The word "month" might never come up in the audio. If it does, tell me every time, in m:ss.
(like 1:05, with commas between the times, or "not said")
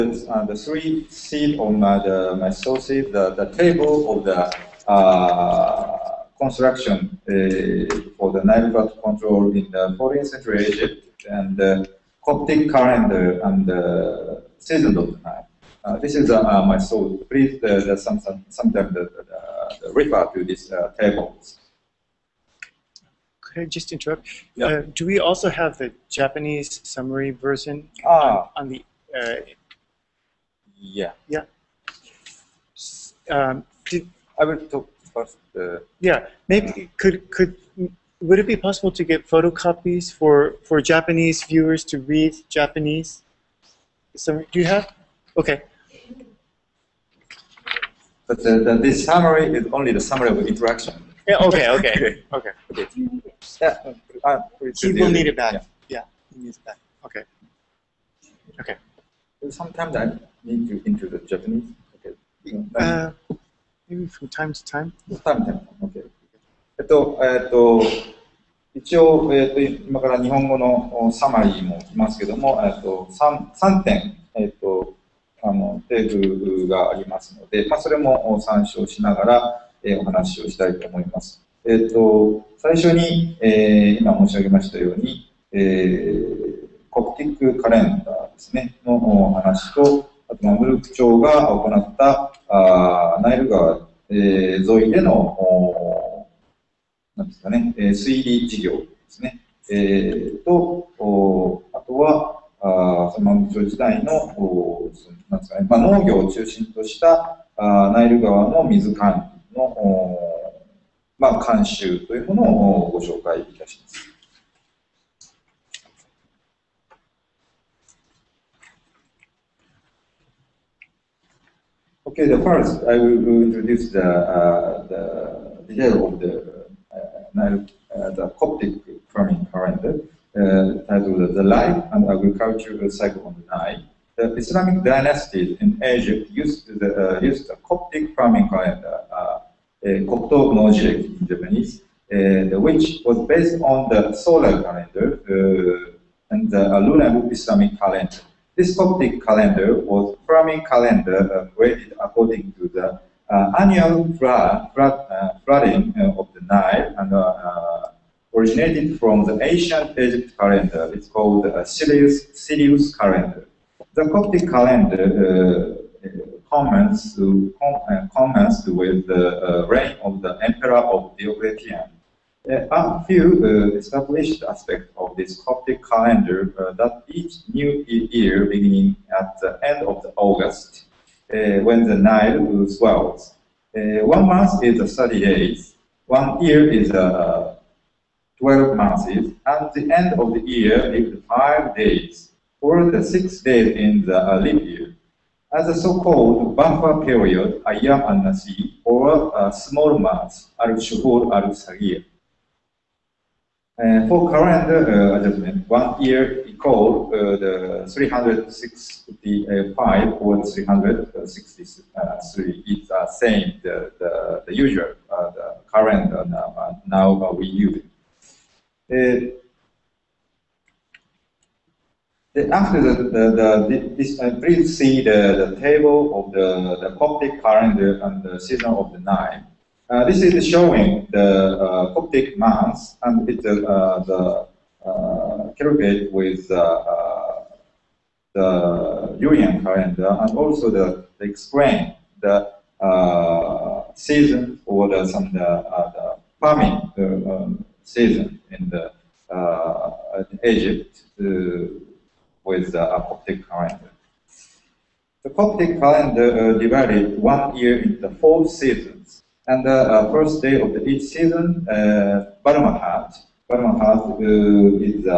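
3:04, 3:08, 3:19.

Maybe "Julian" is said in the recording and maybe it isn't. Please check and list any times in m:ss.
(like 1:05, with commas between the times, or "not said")
3:59.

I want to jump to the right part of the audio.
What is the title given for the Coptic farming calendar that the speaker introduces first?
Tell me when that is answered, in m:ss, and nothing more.
2:11.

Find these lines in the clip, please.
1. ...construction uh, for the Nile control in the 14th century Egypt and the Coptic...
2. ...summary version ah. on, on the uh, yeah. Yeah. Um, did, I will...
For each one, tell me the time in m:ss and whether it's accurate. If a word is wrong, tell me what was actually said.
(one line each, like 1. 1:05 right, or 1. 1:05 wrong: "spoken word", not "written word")
1. 0:06 right
2. 0:26 right.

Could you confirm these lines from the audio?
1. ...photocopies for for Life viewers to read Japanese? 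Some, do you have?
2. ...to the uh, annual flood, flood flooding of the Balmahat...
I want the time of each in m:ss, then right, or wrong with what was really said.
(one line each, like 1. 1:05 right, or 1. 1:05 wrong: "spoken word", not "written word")
1. 0:39 wrong: "Japanese", not "Life"
2. 2:32 wrong: "Nile", not "Balmahat".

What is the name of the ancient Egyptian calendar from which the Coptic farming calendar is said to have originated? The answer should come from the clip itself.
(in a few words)
Sirius calendar.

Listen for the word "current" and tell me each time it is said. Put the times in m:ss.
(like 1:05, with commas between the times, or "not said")
3:24, 3:35.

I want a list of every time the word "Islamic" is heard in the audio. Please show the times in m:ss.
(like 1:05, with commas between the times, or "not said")
2:14, 2:27.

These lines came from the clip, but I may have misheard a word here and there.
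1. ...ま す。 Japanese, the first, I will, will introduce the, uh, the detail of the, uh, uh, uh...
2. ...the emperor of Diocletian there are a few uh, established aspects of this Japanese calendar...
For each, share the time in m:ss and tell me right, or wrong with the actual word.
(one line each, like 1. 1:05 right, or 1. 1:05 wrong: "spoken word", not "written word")
1. 1:53 wrong: "Okay", not "Japanese"
2. 2:50 wrong: "Coptic", not "Japanese".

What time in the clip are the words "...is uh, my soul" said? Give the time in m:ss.
0:16.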